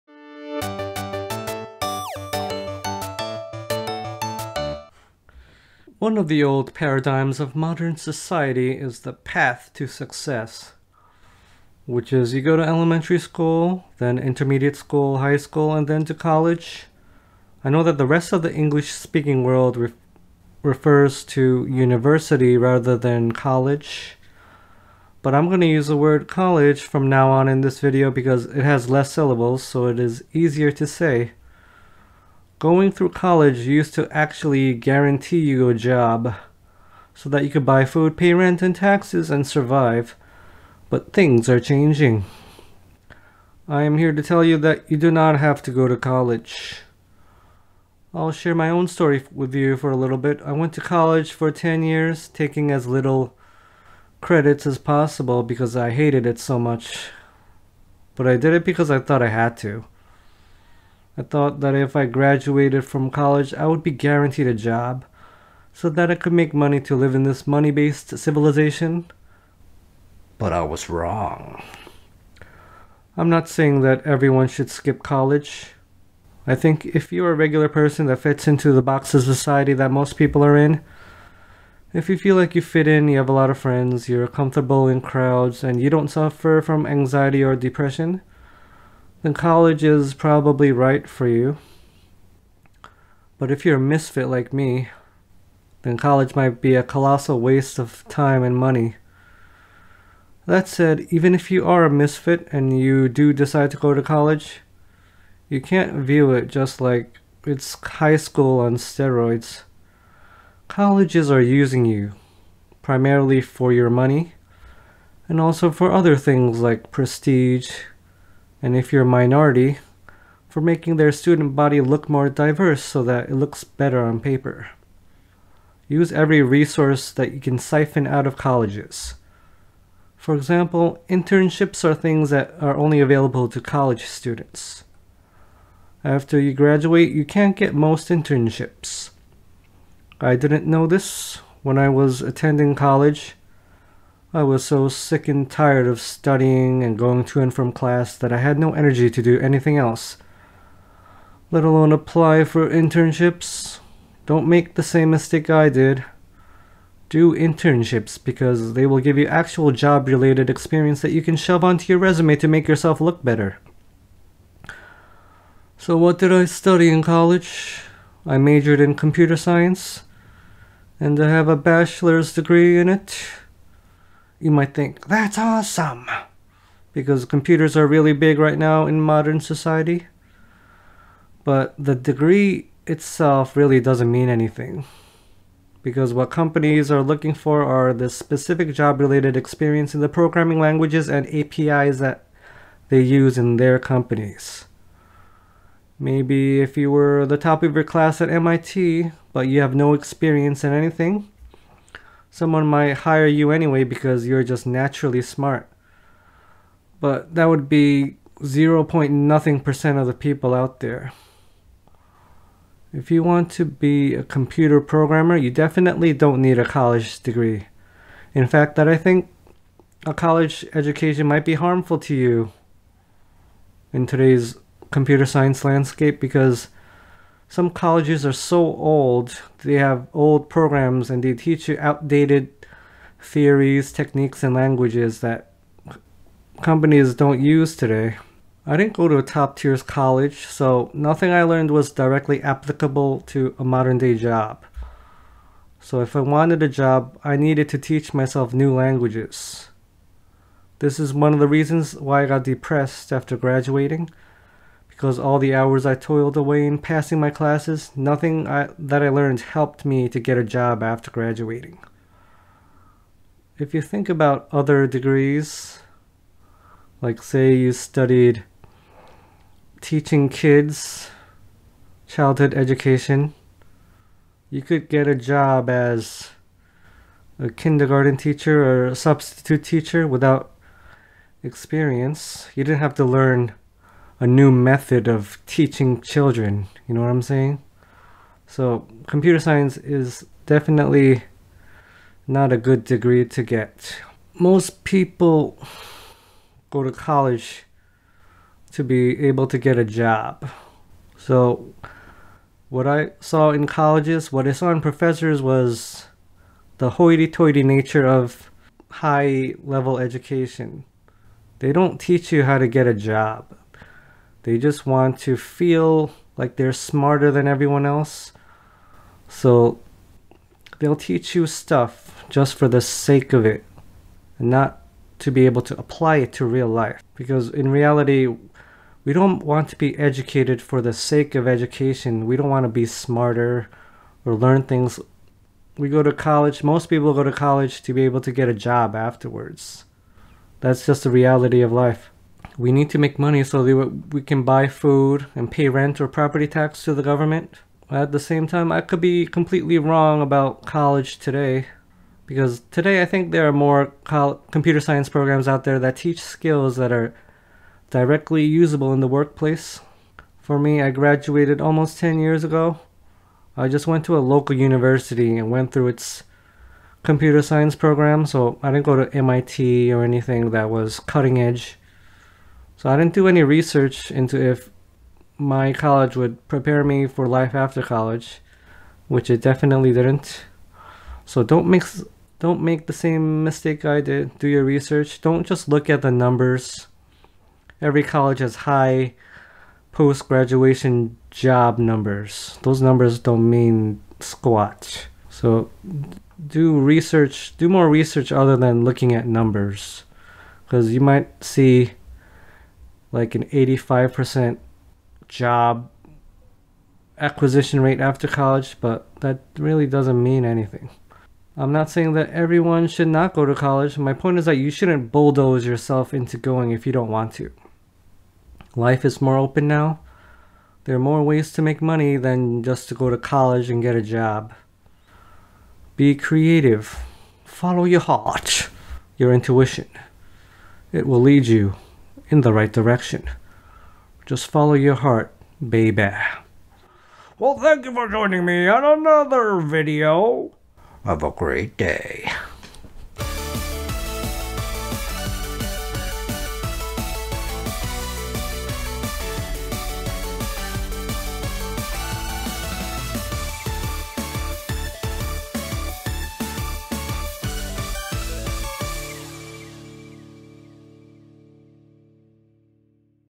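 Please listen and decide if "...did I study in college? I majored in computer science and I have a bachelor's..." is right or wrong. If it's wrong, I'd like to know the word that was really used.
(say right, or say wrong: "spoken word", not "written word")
right.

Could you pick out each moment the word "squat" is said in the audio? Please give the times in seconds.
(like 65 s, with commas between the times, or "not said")
394 s.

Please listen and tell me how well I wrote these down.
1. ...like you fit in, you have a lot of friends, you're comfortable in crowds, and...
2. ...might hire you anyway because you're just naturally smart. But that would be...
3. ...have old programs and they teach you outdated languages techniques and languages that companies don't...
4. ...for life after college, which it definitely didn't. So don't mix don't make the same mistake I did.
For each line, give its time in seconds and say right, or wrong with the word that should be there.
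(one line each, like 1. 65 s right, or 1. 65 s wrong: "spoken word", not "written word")
1. 82 s right
2. 202 s right
3. 229 s wrong: "theories", not "languages"
4. 377 s right.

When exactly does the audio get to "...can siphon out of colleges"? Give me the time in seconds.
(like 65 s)
127 s.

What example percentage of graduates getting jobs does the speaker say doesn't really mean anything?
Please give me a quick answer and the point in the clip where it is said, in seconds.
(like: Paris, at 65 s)
85%, at 403 s.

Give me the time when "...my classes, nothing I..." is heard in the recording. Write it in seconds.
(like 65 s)
257 s.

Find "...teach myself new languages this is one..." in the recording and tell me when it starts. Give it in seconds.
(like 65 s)
247 s.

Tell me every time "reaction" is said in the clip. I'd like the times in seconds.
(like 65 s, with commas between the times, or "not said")
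not said.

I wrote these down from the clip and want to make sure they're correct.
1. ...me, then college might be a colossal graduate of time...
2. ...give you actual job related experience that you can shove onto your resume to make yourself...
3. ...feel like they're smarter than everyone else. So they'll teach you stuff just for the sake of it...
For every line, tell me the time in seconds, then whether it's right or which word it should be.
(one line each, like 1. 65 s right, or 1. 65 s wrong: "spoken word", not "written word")
1. 94 s wrong: "waste", not "graduate"
2. 159 s right
3. 315 s right.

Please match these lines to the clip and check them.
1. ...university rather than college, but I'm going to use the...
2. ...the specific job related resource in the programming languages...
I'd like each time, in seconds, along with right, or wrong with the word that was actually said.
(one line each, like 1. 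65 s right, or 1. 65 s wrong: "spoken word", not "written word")
1. 21 s right
2. 187 s wrong: "experience", not "resource".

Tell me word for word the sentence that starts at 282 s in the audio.
You didn't have to learn a new method of teaching children.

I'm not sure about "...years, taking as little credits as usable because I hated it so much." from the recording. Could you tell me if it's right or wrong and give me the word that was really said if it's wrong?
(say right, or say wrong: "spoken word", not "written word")
wrong: "possible", not "usable".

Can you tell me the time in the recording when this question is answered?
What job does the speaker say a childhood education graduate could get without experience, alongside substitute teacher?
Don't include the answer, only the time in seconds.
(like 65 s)
277 s.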